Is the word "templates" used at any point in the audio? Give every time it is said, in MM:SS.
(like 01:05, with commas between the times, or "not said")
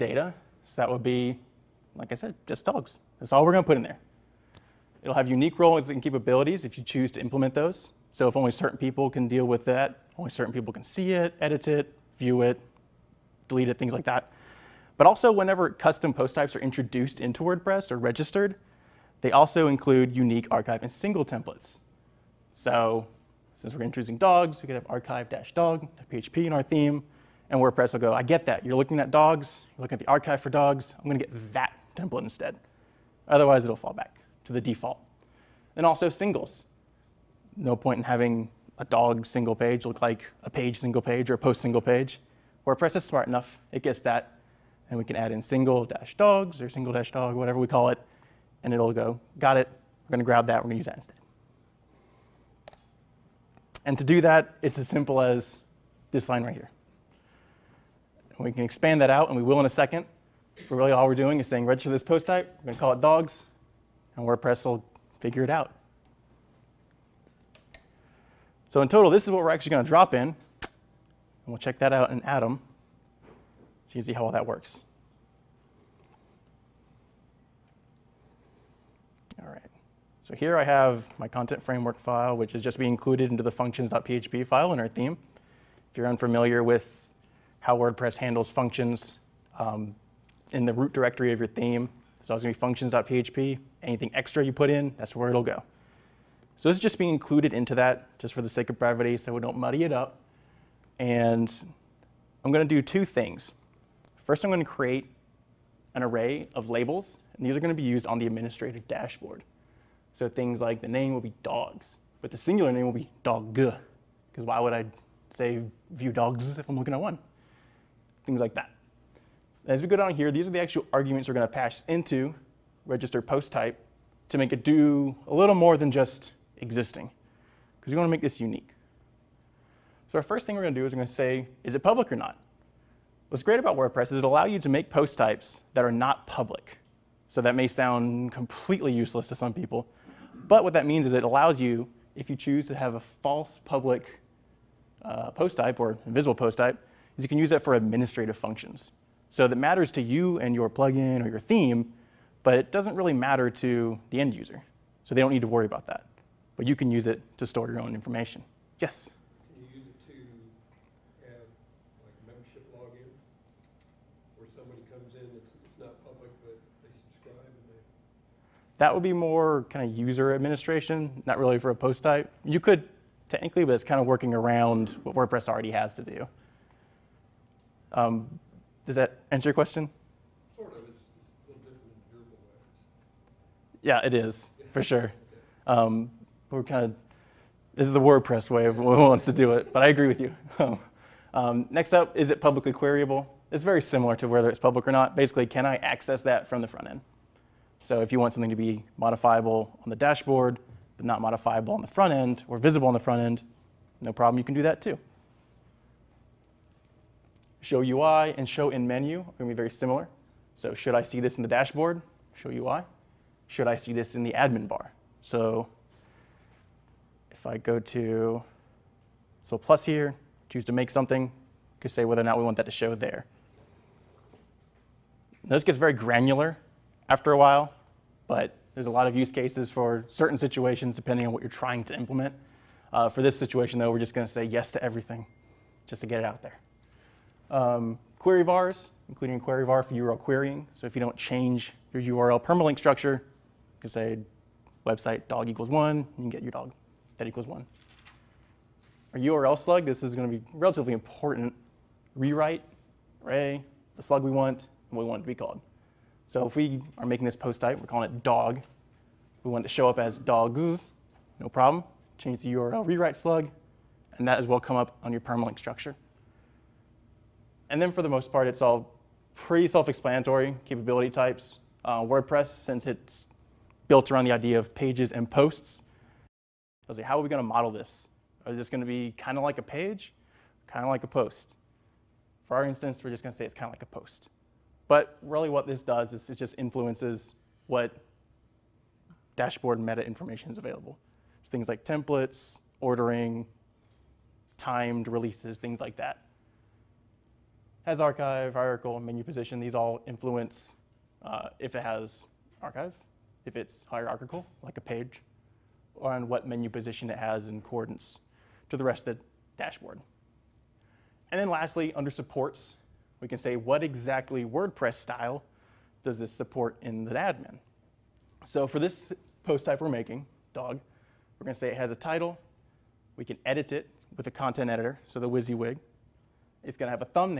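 00:21, 00:31, 04:51.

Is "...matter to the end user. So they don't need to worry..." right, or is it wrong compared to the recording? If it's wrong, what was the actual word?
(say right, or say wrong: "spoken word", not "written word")
right.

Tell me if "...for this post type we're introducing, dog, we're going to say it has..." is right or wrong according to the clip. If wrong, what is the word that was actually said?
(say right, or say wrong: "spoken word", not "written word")
wrong: "making", not "introducing".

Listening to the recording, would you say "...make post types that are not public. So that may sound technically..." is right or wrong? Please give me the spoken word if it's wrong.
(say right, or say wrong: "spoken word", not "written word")
wrong: "completely", not "technically".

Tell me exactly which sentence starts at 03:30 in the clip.
So should I see this in the dashboard?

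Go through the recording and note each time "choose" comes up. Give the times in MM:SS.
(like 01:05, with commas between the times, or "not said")
00:06, 02:22, 03:40.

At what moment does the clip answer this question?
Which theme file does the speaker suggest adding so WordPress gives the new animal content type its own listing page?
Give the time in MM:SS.
00:24.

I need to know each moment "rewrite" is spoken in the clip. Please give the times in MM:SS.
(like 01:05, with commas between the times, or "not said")
04:12, 04:22.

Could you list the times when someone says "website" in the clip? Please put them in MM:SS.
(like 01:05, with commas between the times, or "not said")
04:04.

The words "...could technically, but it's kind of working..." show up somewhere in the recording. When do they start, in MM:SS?
02:52.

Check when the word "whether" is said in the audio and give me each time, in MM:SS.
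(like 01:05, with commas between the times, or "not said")
03:14, 03:42.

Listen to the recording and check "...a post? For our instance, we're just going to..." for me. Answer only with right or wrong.
right.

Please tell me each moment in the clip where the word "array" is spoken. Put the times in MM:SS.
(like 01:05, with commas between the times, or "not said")
01:46, 04:13.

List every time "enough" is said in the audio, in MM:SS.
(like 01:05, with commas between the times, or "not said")
00:43.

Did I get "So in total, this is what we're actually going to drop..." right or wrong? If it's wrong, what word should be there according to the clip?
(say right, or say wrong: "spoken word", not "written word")
right.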